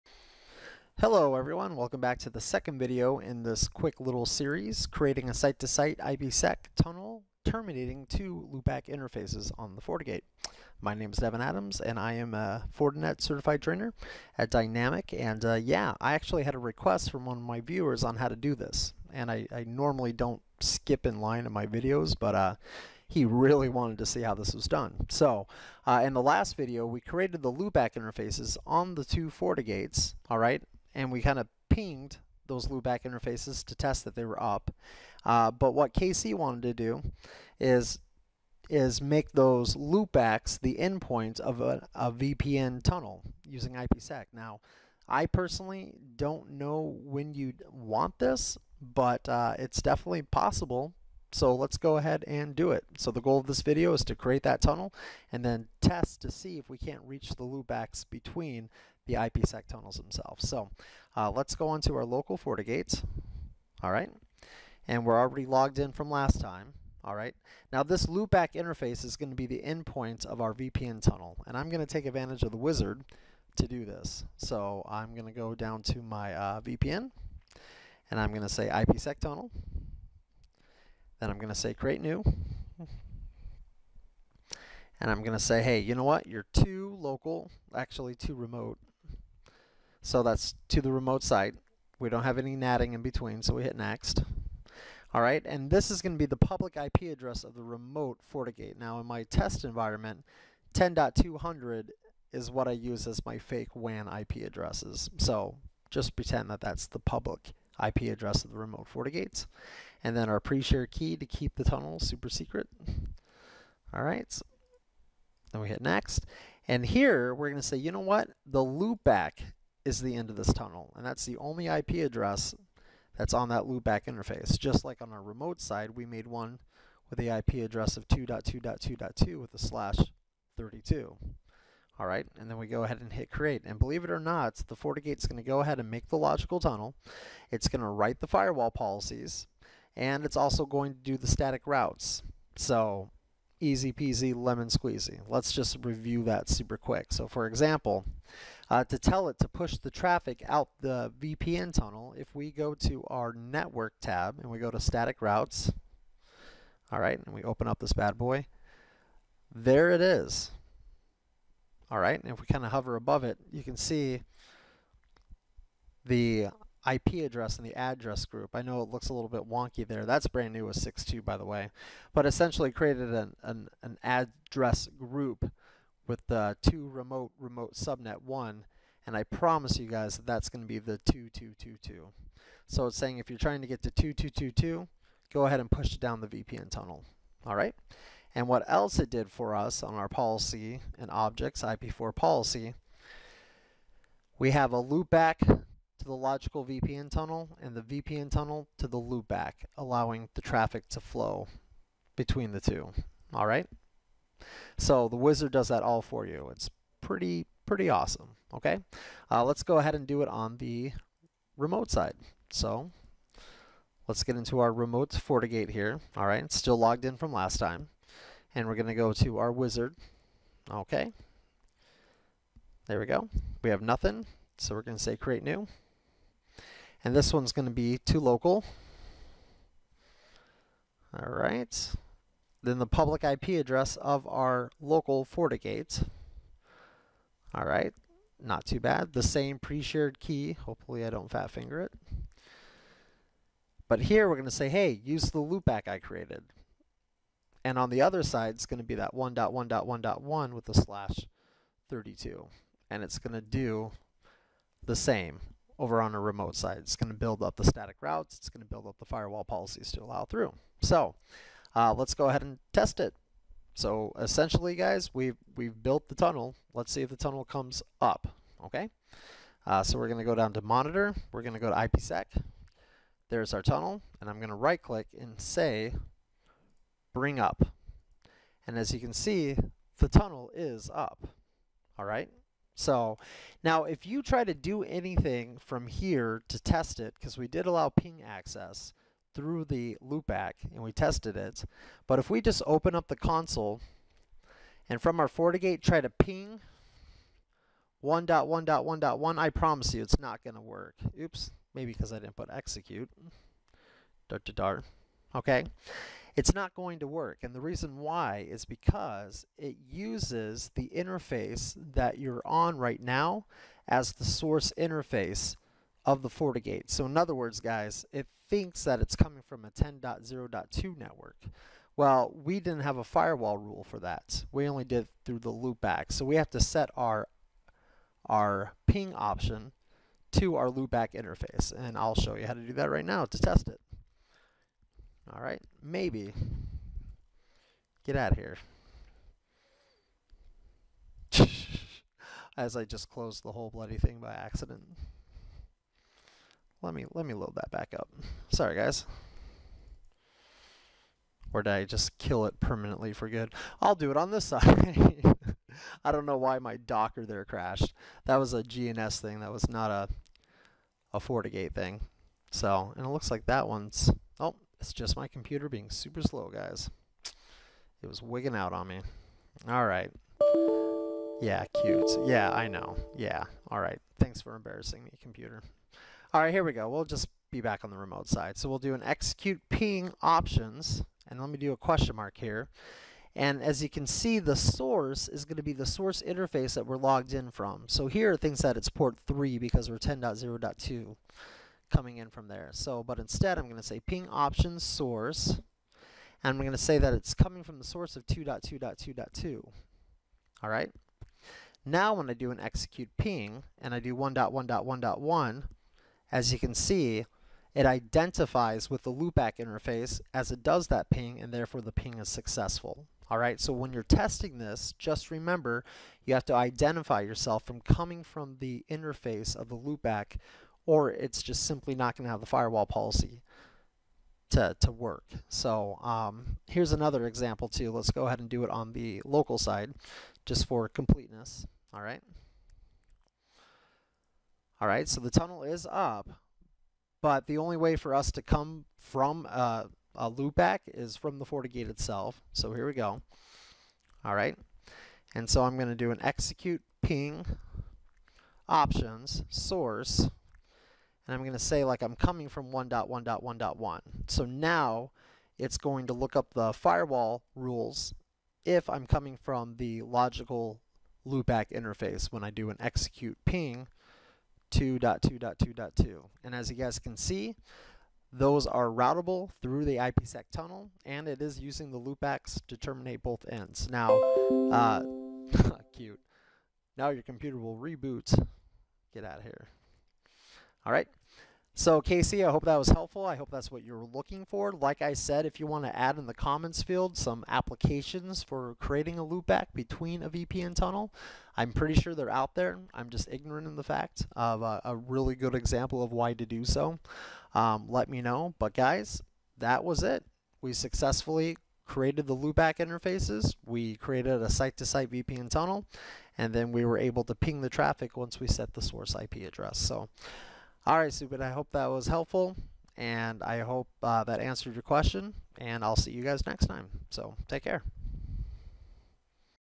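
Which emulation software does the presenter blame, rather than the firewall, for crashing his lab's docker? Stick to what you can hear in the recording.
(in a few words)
GNS.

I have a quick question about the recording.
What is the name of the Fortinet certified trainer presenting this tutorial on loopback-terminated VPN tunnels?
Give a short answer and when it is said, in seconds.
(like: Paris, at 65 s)
Devin Adams, at 11 s.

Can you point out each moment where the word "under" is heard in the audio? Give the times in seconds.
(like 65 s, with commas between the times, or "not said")
not said.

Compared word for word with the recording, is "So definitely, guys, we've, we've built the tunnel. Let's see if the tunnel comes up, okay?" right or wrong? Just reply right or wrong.
wrong.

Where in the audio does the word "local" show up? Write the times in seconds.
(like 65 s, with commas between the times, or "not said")
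62 s, 86 s, 228 s, 234 s, 429 s.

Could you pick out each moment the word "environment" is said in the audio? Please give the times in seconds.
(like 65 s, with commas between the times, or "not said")
99 s.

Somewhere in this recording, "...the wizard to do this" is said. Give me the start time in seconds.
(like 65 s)
72 s.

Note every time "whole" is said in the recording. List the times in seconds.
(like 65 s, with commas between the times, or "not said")
343 s.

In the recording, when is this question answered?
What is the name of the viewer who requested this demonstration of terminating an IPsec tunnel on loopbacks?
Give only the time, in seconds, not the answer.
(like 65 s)
35 s.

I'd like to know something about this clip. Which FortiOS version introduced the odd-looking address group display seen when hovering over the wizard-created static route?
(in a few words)
6.2.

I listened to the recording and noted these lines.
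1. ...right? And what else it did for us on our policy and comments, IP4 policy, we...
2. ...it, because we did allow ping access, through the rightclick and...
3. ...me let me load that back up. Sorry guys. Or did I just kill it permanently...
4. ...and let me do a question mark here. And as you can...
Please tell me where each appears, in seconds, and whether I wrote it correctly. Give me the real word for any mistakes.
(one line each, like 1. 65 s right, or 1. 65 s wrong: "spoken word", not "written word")
1. 187 s wrong: "objects", not "comments"
2. 286 s wrong: "loopback", not "rightclick"
3. 346 s right
4. 381 s right.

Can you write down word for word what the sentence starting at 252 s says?
And it's going to do the same over on a remote side.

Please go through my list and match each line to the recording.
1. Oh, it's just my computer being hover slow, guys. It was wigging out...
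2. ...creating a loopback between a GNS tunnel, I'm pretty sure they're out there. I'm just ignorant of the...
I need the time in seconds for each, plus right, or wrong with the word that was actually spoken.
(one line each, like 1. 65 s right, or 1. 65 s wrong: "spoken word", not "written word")
1. 364 s wrong: "super", not "hover"
2. 488 s wrong: "VPN", not "GNS".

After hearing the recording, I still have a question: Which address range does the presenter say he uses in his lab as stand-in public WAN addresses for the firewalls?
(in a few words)
10.200.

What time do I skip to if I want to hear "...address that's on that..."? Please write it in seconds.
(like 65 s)
122 s.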